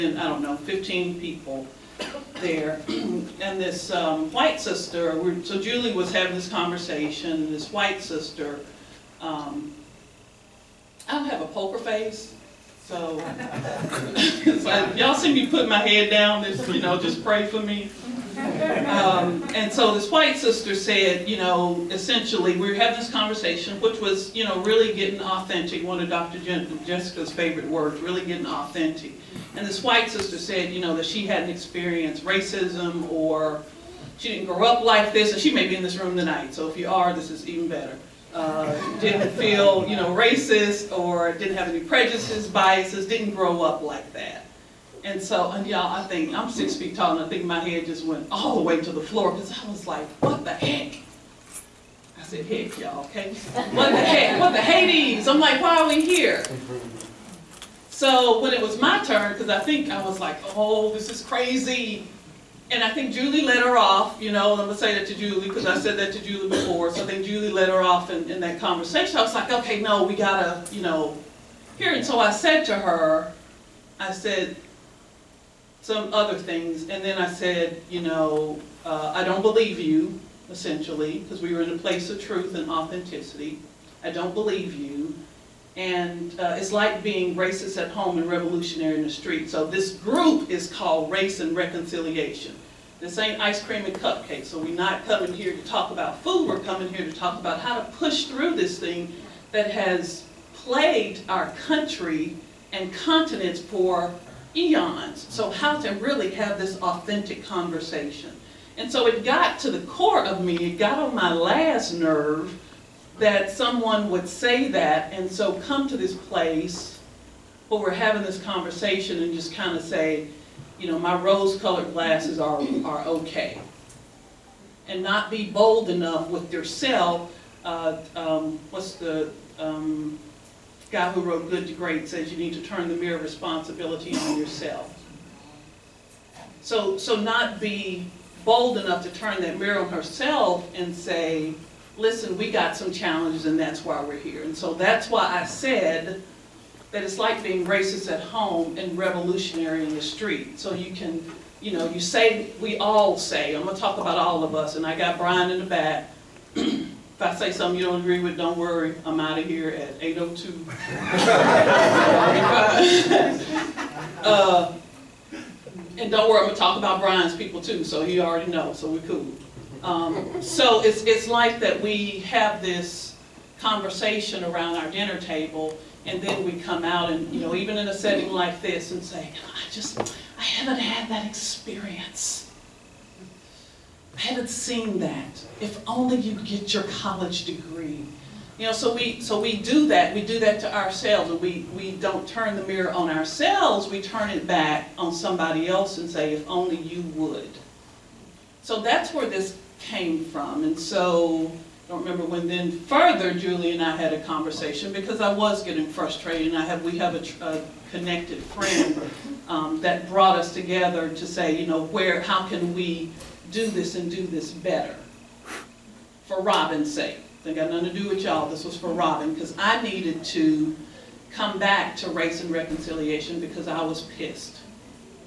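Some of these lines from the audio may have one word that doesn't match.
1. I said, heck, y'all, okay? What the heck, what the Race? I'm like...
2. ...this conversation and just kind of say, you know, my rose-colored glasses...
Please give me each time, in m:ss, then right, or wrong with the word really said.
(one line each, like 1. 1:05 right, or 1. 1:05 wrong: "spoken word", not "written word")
1. 0:52 wrong: "Hades", not "Race"
2. 1:58 right.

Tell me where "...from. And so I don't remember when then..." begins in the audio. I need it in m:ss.
3:20.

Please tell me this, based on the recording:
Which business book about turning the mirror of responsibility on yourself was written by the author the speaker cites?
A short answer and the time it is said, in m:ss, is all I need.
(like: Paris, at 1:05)
Good to Great, at 2:11.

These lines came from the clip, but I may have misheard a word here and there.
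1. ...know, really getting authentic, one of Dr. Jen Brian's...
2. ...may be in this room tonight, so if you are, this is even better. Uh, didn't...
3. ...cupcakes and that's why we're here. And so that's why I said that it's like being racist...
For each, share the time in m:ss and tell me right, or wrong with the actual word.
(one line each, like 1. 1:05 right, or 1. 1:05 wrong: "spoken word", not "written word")
1. 0:24 wrong: "Jessica", not "Brian"
2. 0:35 right
3. 2:22 wrong: "challenges", not "cupcakes".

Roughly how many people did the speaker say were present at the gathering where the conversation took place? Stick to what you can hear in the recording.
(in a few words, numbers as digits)
15.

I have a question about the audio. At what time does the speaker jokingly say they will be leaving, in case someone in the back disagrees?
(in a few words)
8:02.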